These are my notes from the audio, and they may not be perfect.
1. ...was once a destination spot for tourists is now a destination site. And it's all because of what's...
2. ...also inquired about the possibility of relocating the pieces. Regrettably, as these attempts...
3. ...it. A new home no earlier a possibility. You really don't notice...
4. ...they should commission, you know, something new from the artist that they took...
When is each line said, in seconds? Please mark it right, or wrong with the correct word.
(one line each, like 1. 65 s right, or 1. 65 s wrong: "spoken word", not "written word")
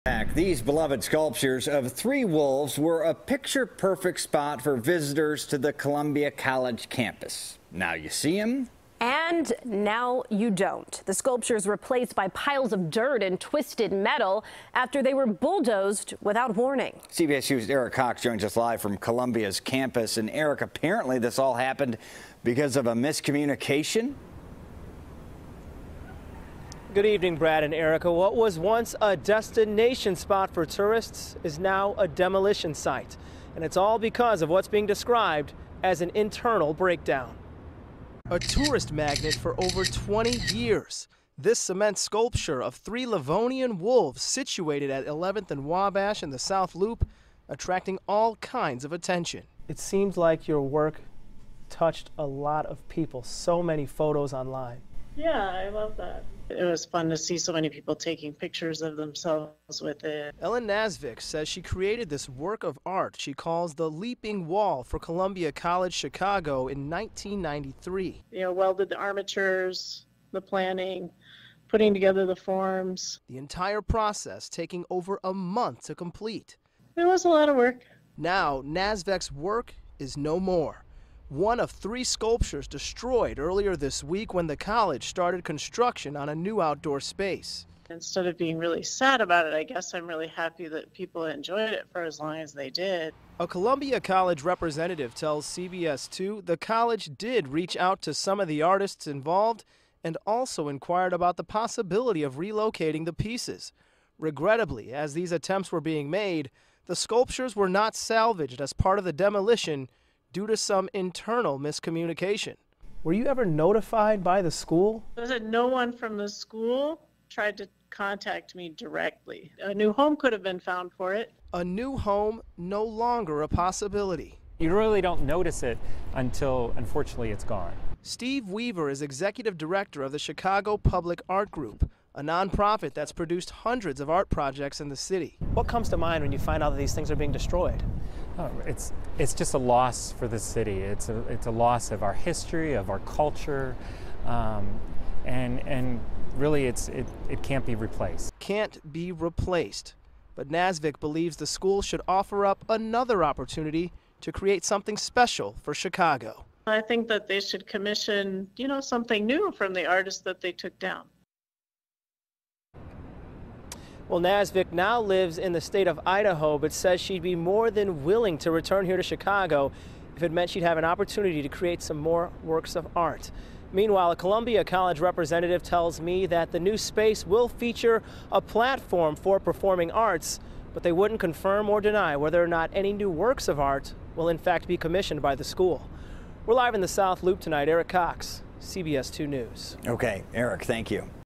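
1. 28 s wrong: "demolition", not "destination"
2. 100 s right
3. 121 s wrong: "longer", not "earlier"
4. 157 s right.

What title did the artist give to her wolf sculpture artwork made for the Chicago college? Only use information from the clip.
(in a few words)
Leaping Wall.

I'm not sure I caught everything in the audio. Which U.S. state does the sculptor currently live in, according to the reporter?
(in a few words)
Idaho.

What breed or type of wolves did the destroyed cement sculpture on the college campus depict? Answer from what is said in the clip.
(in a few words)
Livonian.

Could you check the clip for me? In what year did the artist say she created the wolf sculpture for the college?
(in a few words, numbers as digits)
1993.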